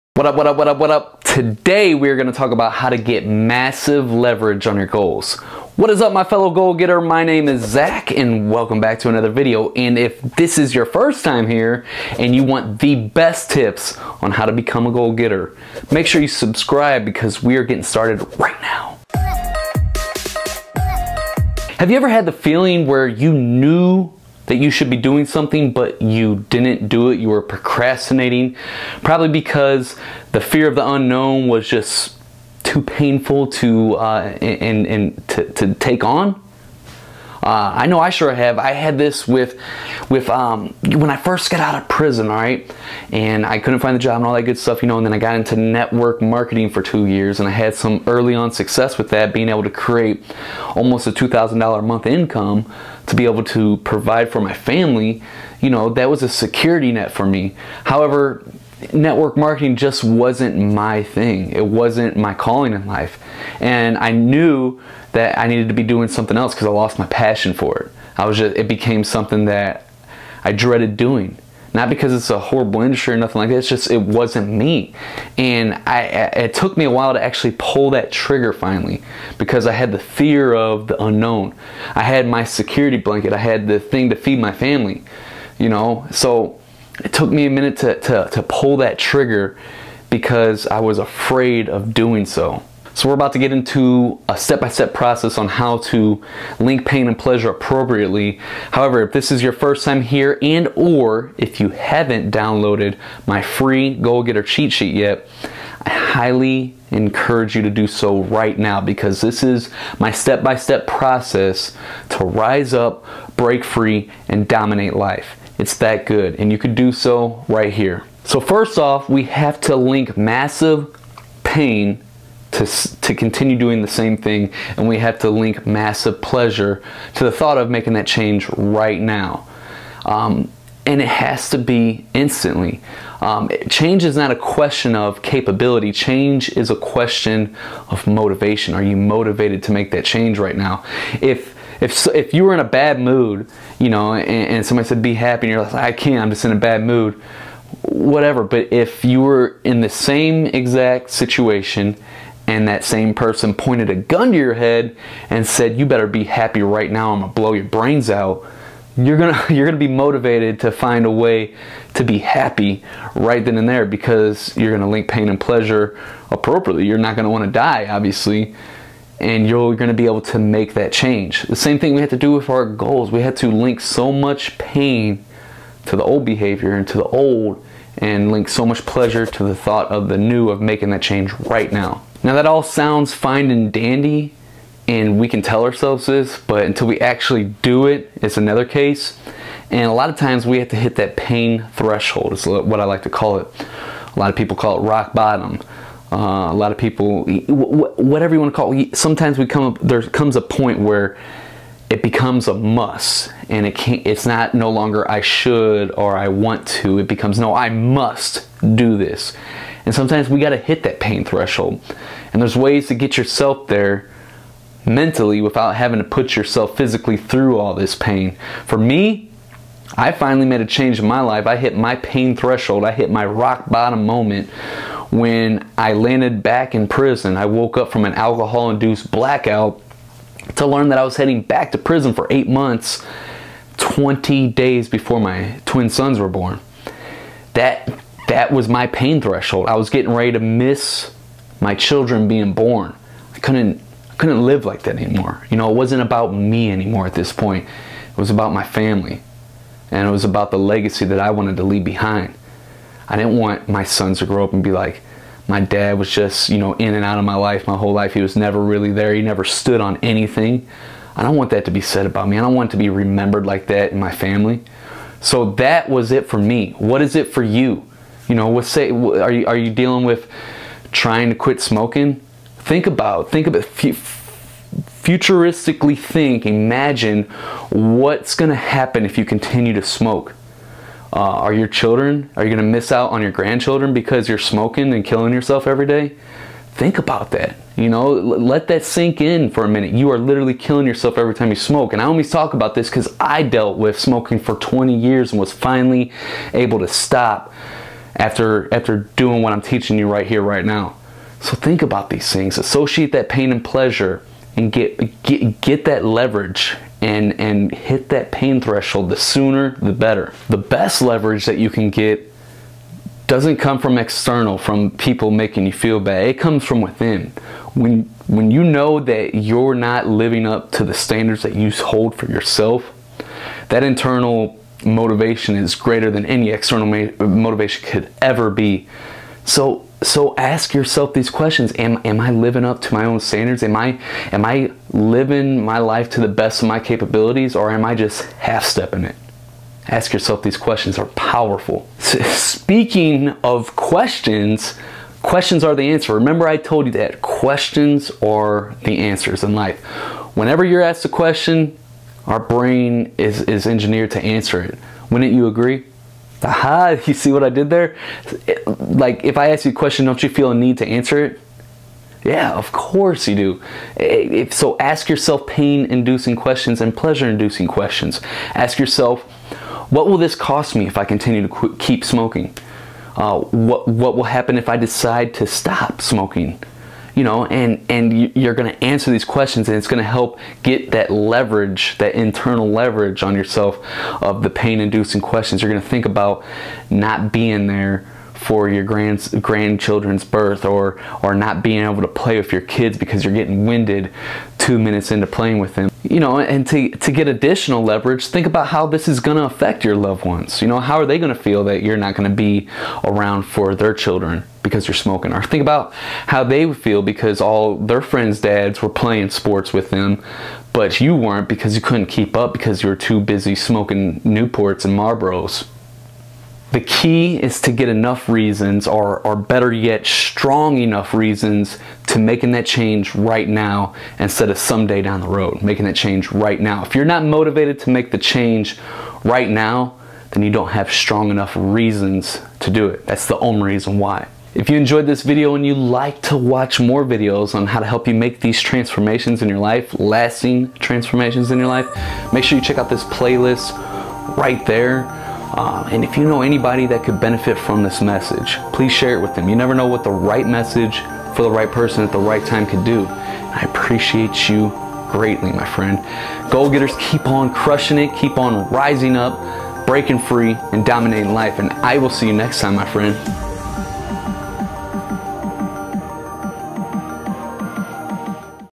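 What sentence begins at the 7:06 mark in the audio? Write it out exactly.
If you're not motivated to make the change right now, then you don't have strong enough reasons to do it.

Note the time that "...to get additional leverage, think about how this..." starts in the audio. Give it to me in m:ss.
6:36.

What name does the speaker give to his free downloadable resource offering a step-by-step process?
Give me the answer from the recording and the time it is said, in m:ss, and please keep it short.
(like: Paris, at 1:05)
Goal Getter cheat sheet, at 1:43.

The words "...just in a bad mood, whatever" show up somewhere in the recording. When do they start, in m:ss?
2:26.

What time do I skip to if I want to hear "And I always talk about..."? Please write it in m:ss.
4:51.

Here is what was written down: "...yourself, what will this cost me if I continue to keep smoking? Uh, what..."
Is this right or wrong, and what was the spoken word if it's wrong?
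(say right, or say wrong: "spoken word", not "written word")
right.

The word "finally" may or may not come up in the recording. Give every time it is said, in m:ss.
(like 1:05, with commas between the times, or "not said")
1:18, 3:40, 4:55.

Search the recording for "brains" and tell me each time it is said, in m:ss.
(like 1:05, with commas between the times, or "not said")
2:37, 5:52.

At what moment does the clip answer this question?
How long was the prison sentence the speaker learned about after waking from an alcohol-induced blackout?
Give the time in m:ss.
3:52.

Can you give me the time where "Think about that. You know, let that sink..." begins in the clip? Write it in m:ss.
4:46.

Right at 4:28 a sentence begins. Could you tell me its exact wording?
You know, what say are you are you dealing with trying to quit smoking?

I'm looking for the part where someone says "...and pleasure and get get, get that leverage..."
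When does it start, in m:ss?
5:03.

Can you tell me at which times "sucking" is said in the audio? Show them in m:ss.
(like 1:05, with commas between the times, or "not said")
not said.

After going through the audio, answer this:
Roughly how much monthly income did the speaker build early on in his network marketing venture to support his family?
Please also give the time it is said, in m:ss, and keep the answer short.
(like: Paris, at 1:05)
$2,000, at 0:51.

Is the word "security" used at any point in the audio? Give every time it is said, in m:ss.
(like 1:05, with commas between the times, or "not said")
0:56, 1:22.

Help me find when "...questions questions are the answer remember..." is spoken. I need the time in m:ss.
5:43.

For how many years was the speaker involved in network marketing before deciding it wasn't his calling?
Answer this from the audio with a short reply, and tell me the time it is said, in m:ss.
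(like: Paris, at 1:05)
2, at 0:46.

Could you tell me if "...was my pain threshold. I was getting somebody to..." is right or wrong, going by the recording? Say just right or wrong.
wrong.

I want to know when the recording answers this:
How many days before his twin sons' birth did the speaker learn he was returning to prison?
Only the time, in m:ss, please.
3:53.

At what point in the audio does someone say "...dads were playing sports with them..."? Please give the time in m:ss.
6:48.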